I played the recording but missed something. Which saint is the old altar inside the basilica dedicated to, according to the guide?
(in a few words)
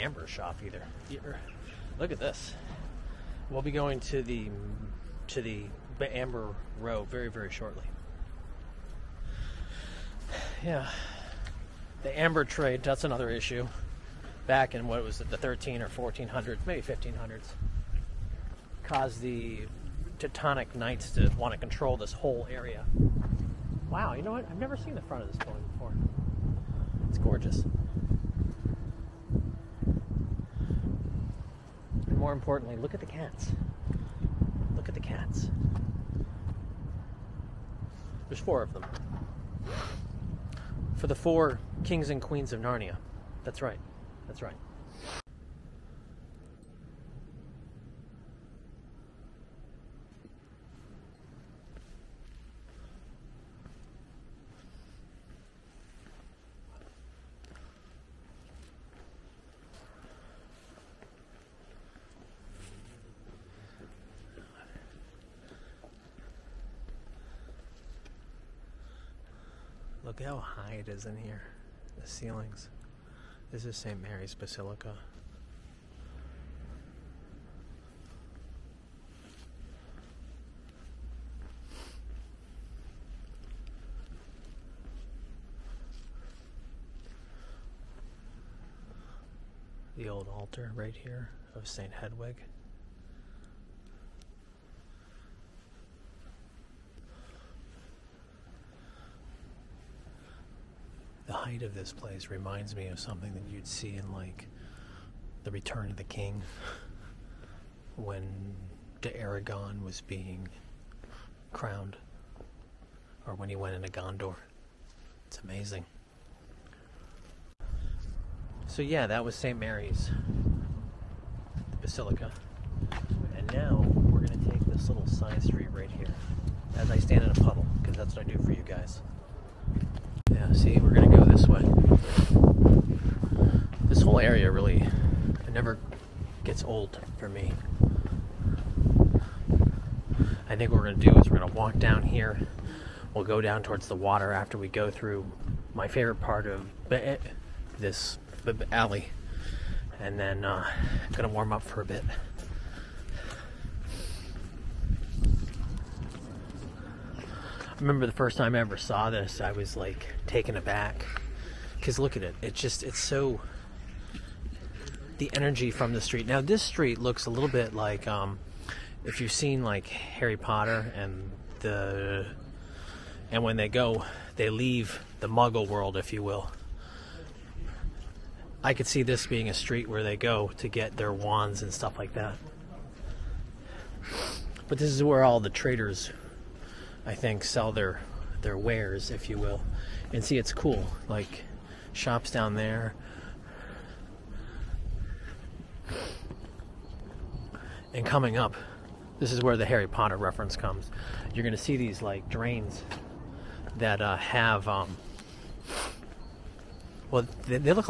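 St. Hedwig.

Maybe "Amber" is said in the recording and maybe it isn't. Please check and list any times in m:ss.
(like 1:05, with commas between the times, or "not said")
0:06, 0:12.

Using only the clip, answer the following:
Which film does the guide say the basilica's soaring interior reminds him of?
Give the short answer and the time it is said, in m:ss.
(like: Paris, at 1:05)
The Return of the King, at 1:45.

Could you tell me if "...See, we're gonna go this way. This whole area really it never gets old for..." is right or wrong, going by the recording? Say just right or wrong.
right.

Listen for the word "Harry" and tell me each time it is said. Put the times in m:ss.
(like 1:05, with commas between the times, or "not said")
2:49, 3:19.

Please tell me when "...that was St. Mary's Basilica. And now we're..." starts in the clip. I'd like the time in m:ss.
1:59.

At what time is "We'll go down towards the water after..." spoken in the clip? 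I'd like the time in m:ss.
2:23.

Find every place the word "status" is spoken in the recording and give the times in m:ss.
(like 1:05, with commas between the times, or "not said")
not said.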